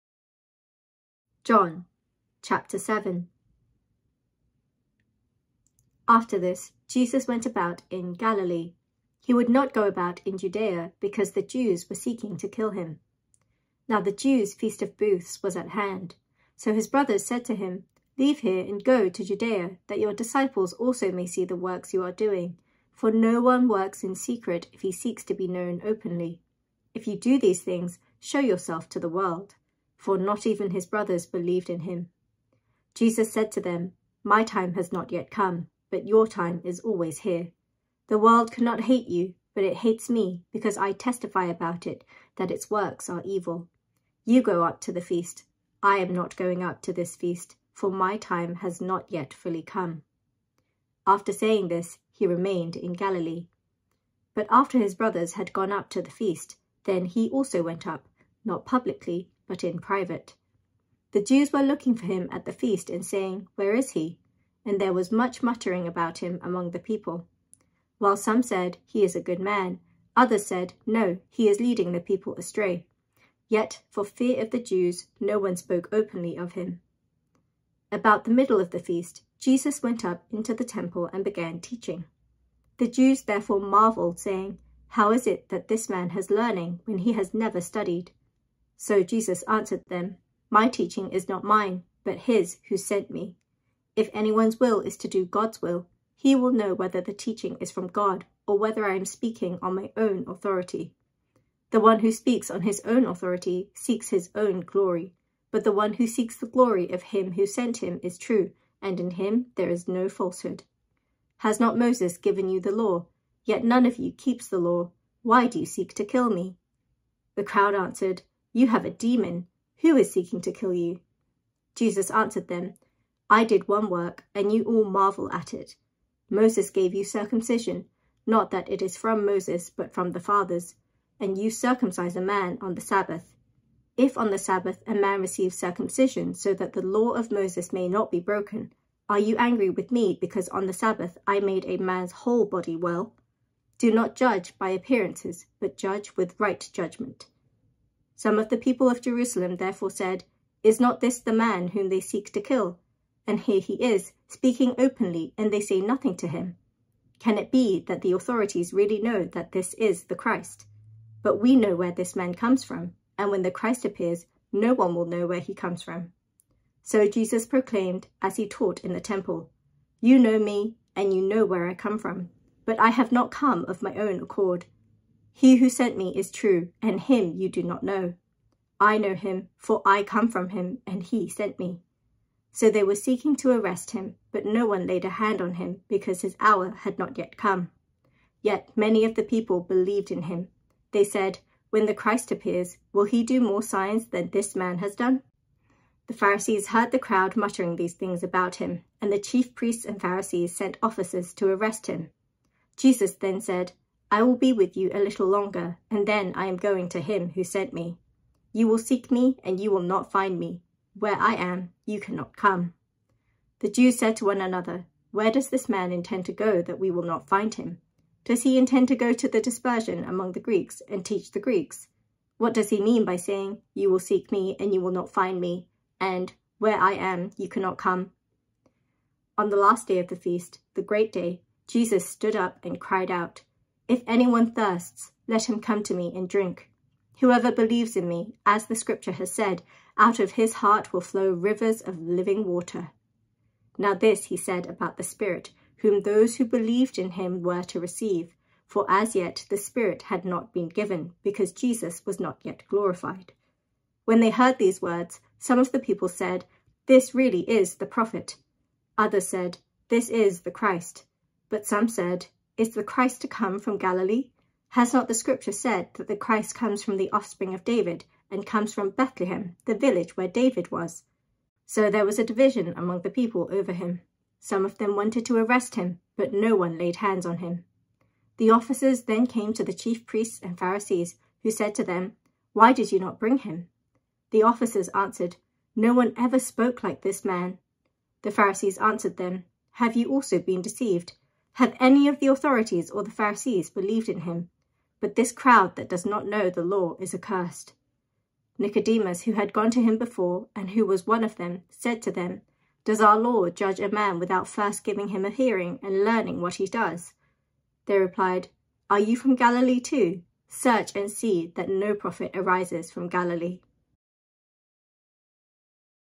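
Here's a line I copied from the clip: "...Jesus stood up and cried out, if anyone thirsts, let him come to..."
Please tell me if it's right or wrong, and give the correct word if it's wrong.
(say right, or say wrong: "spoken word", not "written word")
right.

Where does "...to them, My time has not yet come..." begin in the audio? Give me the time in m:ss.
0:33.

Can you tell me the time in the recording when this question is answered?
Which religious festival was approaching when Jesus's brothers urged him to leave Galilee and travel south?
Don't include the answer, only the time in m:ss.
0:14.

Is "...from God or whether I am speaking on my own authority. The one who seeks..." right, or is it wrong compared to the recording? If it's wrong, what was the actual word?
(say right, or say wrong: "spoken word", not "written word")
wrong: "speaks", not "seeks".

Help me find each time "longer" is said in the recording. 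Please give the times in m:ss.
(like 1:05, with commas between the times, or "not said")
3:25.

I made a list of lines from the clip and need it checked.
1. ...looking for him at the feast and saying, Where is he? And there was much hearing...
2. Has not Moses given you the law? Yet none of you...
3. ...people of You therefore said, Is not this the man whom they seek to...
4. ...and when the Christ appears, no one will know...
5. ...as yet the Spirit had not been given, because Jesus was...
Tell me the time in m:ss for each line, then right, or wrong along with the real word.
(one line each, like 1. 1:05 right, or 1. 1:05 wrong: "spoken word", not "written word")
1. 1:01 wrong: "muttering", not "hearing"
2. 1:51 right
3. 2:28 wrong: "Jerusalem", not "You"
4. 2:43 right
5. 4:08 right.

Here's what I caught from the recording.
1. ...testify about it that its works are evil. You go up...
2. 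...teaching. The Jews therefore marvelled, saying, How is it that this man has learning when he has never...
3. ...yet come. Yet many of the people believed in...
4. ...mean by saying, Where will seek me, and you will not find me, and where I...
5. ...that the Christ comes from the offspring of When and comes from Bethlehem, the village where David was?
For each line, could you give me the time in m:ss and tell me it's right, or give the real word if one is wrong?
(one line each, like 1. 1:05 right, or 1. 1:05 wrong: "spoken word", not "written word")
1. 0:40 right
2. 1:21 right
3. 3:07 right
4. 3:42 wrong: "You", not "Where"
5. 4:25 wrong: "David", not "When".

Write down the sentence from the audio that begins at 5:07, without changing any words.
They replied, Are you from Galilee too?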